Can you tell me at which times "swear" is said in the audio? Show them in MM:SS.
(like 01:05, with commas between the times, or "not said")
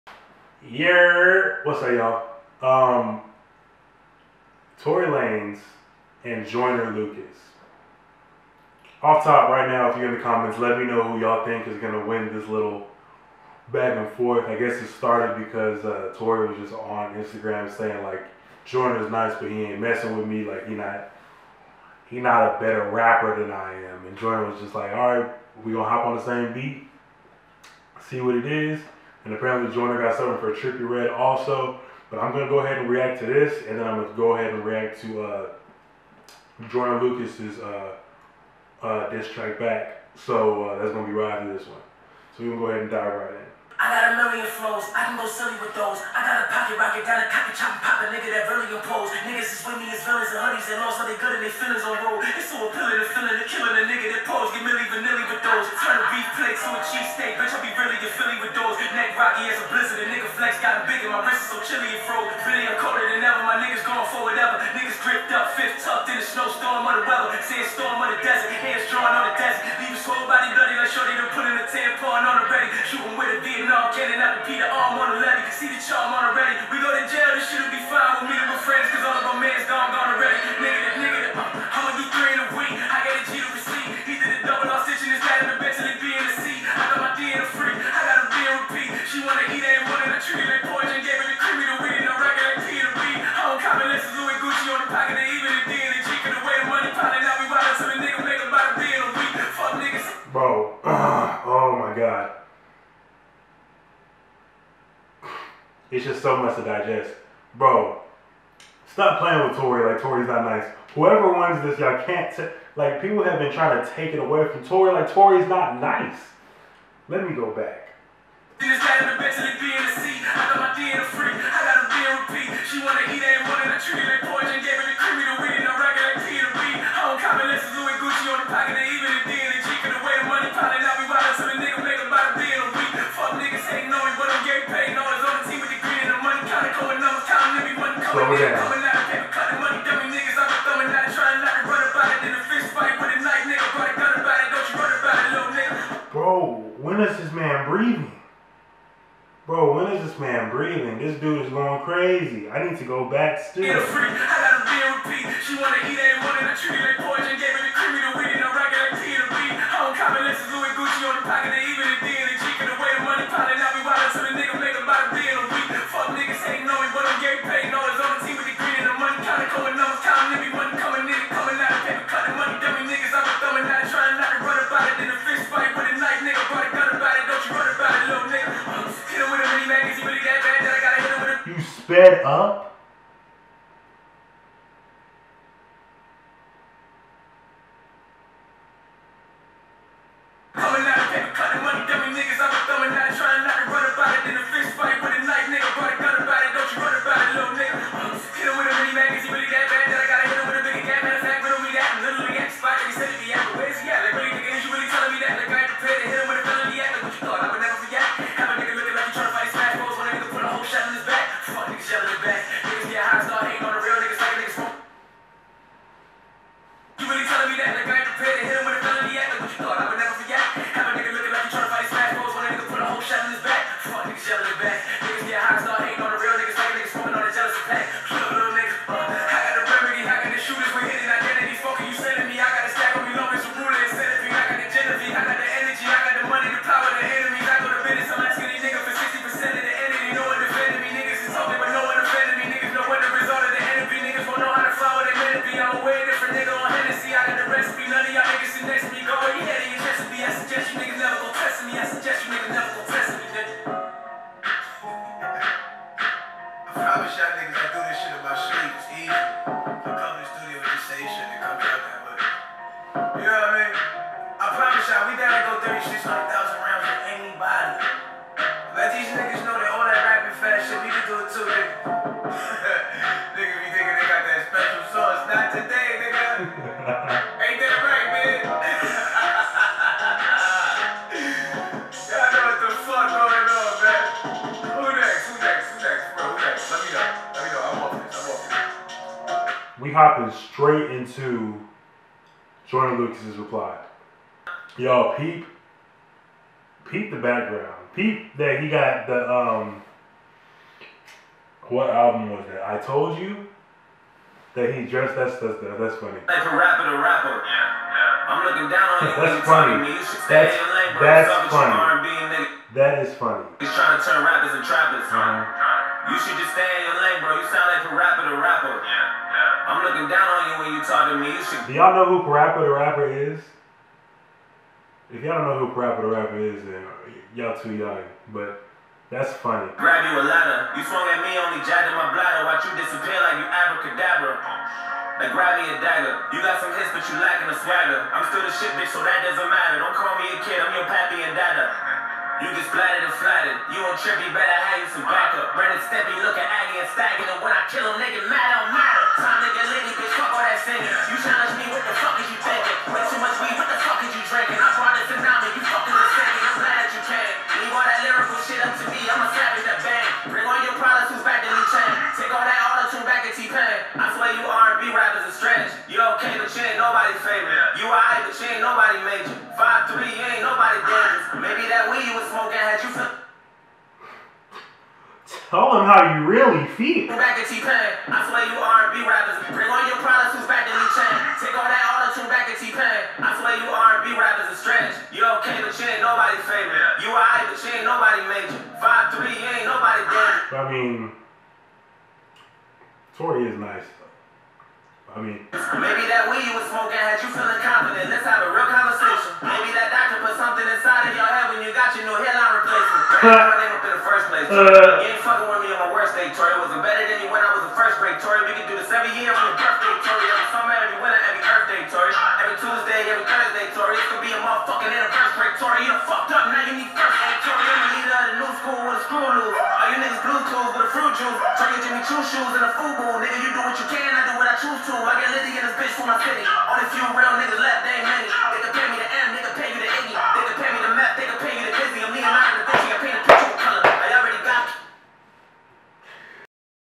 06:18, 06:23.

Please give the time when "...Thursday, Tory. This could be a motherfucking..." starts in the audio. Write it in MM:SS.
06:53.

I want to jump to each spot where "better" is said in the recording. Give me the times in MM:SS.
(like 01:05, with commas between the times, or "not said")
00:22, 05:44, 06:46.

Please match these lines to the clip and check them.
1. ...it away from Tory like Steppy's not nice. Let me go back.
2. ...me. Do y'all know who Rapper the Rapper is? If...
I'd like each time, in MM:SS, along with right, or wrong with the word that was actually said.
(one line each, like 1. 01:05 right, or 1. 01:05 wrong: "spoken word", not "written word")
1. 01:54 wrong: "Tory", not "Steppy"
2. 05:21 wrong: "Parappa", not "Rapper".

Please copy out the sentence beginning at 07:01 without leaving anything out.
Tory, Jimmy Choo shoes and a FUBU.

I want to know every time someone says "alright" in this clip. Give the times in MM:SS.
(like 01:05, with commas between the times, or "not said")
06:27.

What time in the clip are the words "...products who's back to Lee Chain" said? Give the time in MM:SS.
06:20.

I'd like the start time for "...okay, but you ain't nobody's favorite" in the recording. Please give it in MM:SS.
06:25.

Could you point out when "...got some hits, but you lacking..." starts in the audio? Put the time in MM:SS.
05:36.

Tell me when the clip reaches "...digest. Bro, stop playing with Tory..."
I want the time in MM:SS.
01:46.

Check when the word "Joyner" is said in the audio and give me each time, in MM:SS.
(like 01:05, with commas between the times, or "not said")
00:06, 00:18, 00:24, 00:29, 00:36, 04:52.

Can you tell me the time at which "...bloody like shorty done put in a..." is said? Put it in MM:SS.
01:10.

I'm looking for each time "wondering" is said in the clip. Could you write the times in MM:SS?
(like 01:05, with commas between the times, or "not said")
not said.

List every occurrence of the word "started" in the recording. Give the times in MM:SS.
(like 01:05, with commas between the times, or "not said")
00:14.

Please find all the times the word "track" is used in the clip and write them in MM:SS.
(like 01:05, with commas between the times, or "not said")
00:39.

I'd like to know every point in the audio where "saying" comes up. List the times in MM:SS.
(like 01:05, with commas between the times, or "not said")
00:17.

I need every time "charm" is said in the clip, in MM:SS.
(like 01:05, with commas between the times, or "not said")
01:15.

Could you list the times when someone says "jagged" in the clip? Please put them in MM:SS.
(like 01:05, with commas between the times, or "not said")
05:31.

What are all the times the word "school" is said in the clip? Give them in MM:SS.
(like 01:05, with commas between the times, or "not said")
06:58.